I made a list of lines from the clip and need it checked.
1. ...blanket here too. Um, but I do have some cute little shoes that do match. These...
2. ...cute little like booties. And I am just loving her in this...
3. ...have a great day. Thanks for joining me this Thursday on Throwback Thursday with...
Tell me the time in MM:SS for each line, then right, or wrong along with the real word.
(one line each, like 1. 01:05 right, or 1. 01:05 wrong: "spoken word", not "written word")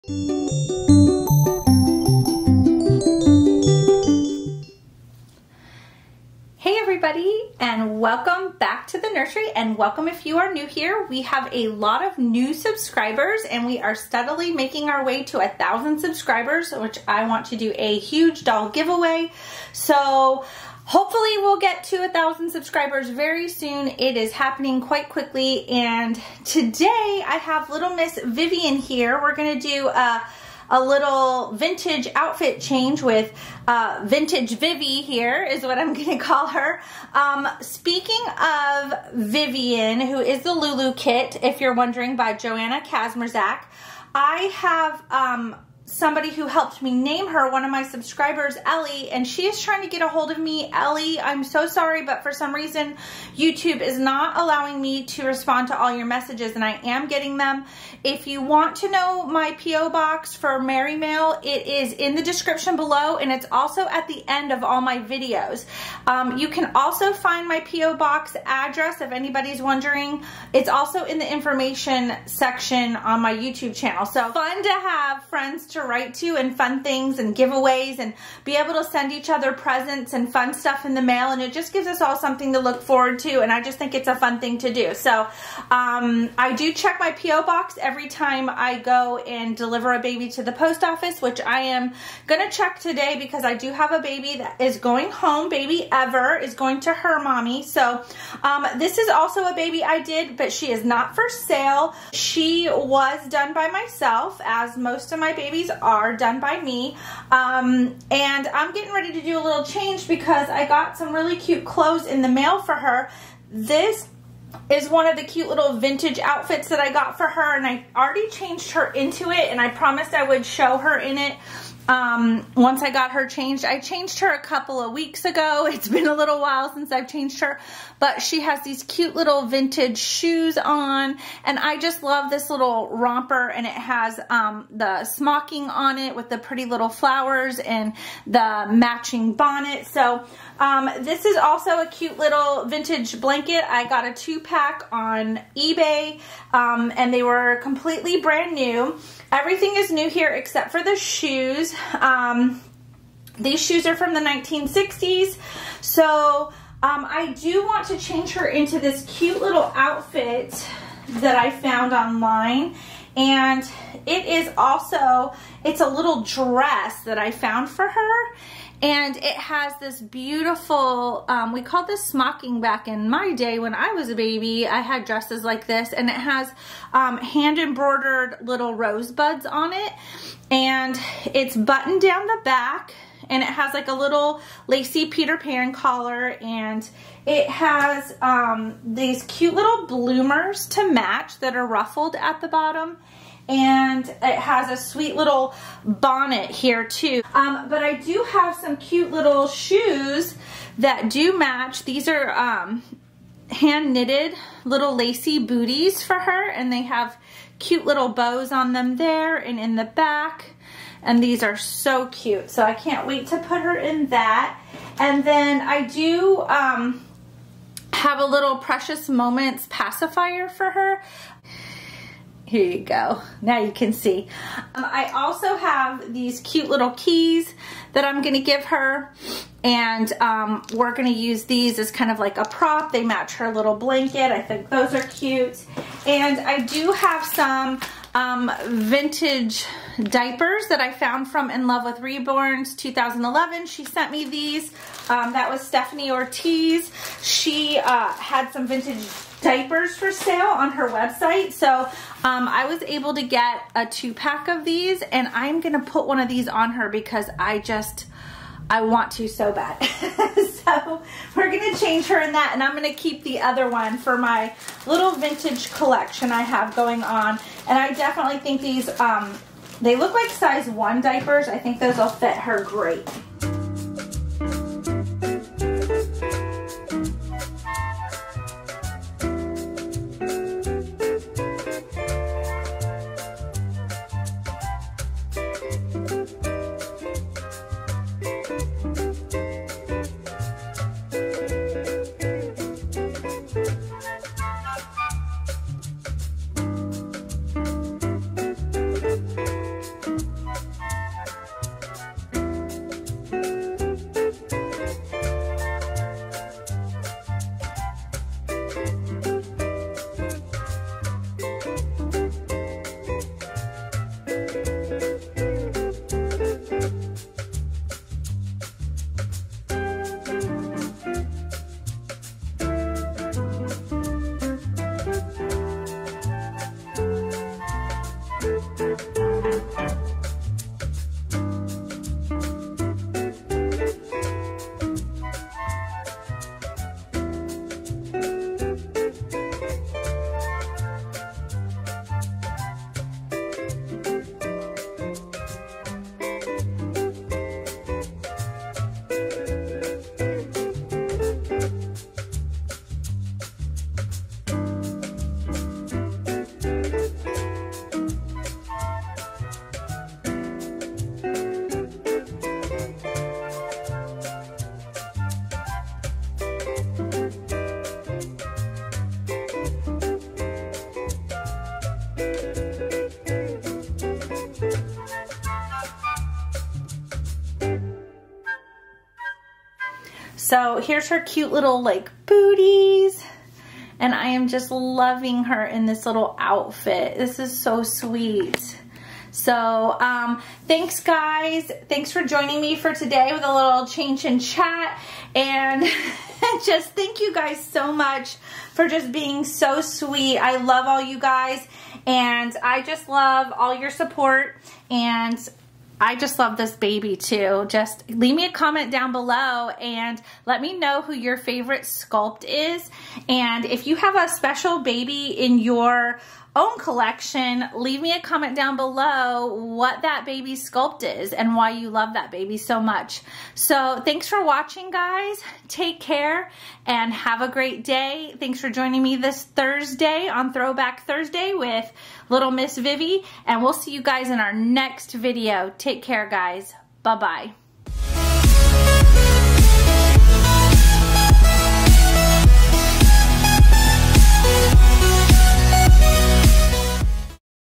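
1. 03:15 wrong: "bonnet", not "blanket"
2. 06:21 right
3. 07:07 right.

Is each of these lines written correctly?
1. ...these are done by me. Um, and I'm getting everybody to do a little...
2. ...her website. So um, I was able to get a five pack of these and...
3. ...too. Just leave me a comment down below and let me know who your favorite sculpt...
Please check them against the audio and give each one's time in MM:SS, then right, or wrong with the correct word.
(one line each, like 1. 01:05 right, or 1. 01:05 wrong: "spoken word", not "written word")
1. 01:45 wrong: "ready", not "everybody"
2. 04:10 wrong: "two", not "five"
3. 06:47 right.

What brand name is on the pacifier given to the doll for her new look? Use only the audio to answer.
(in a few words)
Precious Moments.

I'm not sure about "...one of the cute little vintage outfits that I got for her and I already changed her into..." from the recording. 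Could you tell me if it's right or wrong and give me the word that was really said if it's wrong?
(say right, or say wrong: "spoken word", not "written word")
right.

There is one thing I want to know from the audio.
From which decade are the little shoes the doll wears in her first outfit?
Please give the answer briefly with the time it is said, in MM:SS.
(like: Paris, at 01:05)
1960s, at 02:34.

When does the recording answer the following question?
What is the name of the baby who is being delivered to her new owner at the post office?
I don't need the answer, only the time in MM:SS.
01:35.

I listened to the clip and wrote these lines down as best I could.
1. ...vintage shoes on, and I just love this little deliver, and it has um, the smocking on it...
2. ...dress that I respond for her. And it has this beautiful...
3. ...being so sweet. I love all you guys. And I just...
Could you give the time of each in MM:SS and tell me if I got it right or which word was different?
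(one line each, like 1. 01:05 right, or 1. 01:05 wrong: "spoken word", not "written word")
1. 02:09 wrong: "romper", not "deliver"
2. 02:46 wrong: "found", not "respond"
3. 06:39 right.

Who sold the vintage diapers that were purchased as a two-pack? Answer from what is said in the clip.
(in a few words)
Stephanie Ortiz.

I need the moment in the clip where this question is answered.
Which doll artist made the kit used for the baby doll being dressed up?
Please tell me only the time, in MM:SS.
00:42.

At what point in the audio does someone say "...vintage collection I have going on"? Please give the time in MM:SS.
04:25.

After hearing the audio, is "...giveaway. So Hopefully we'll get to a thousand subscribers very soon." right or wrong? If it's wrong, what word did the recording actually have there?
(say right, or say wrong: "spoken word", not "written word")
right.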